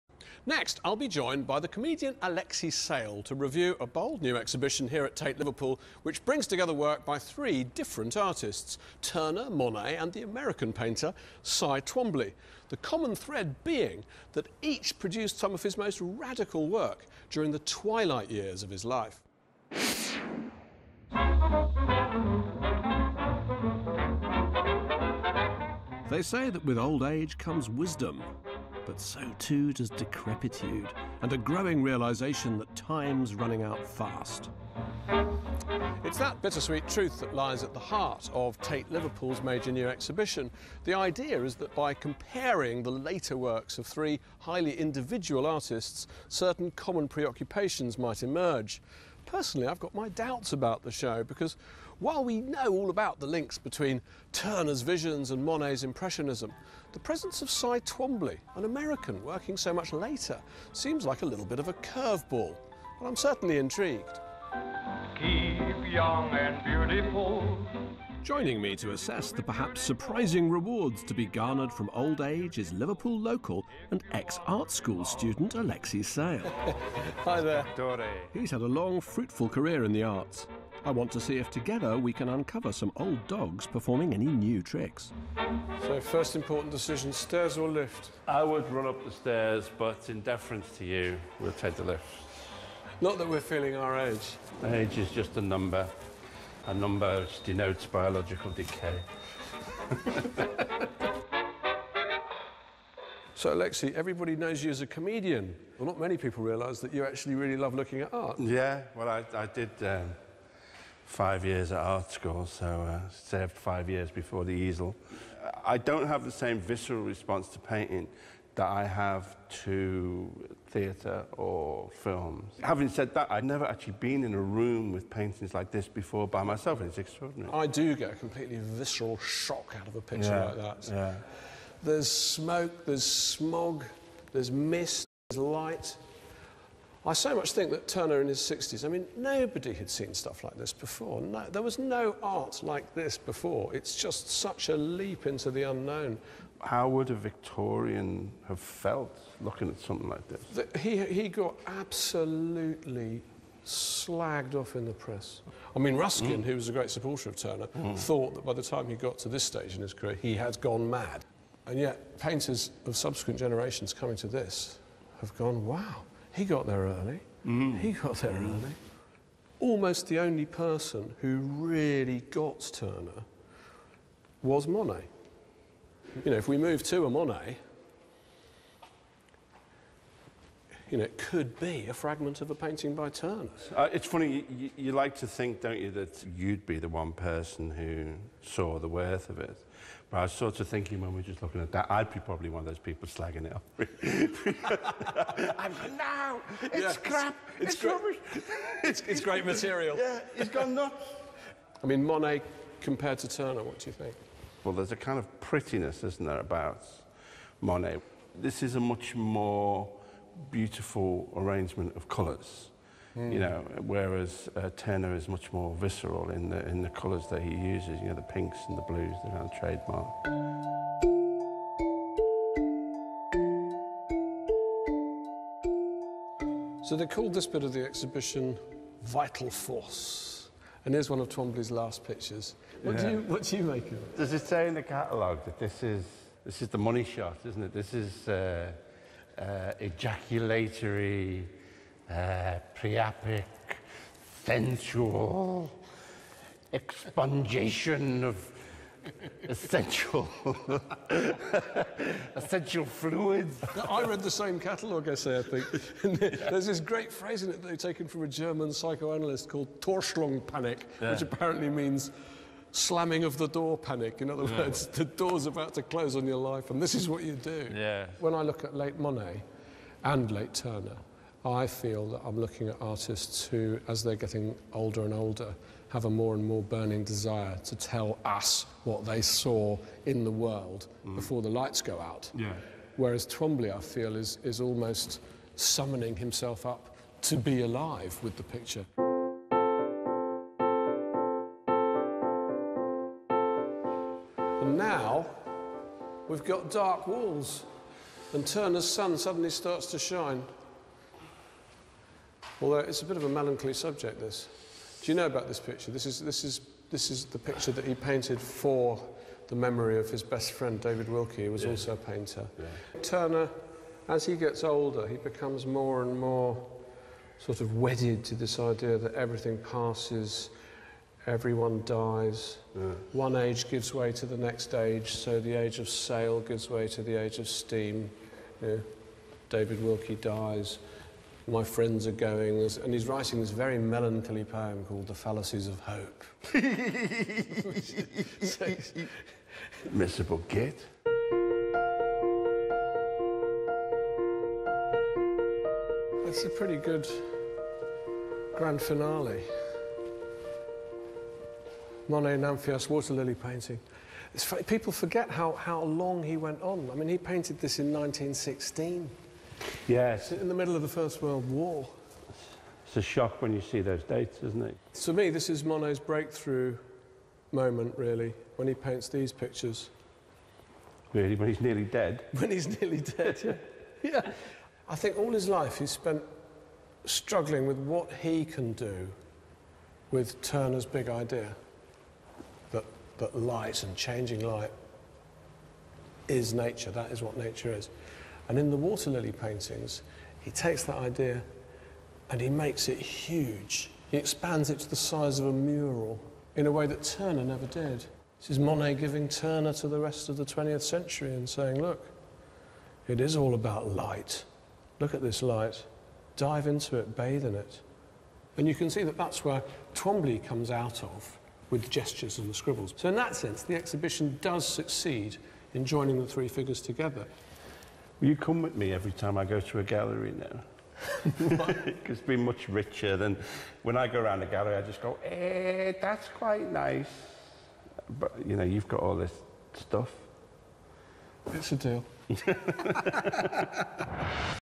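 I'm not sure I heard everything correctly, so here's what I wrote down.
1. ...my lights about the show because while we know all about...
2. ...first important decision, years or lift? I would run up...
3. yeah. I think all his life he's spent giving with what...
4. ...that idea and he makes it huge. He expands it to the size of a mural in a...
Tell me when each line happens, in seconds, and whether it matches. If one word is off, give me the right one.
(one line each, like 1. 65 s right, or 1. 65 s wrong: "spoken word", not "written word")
1. 49 s wrong: "doubts", not "lights"
2. 86 s wrong: "stairs", not "years"
3. 374 s wrong: "struggling", not "giving"
4. 390 s right.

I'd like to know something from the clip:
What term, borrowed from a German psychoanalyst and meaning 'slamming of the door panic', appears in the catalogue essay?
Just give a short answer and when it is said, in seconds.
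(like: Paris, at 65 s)
Torschluss panic, at 259 s.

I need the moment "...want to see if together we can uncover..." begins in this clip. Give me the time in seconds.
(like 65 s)
80 s.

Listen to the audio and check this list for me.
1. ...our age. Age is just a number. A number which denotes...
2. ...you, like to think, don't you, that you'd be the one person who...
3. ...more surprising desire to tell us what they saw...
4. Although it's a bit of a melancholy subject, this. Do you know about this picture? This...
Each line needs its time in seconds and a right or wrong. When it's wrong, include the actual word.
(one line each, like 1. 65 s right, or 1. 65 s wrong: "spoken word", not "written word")
1. 93 s right
2. 184 s right
3. 276 s wrong: "burning", not "surprising"
4. 302 s right.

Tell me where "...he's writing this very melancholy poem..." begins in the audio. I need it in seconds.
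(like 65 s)
332 s.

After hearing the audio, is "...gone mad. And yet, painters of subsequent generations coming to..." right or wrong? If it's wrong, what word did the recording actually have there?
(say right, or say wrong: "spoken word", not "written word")
right.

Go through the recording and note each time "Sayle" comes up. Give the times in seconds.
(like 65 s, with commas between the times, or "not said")
2 s, 76 s.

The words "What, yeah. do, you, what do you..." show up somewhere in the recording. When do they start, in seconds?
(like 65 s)
232 s.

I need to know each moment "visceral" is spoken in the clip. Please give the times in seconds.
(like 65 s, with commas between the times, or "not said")
116 s, 128 s, 215 s.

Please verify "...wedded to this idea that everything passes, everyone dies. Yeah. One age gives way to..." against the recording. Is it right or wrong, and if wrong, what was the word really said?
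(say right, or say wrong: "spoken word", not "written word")
right.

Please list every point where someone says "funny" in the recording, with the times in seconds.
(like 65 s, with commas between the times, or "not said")
184 s, 354 s.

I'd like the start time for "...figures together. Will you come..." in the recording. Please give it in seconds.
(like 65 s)
416 s.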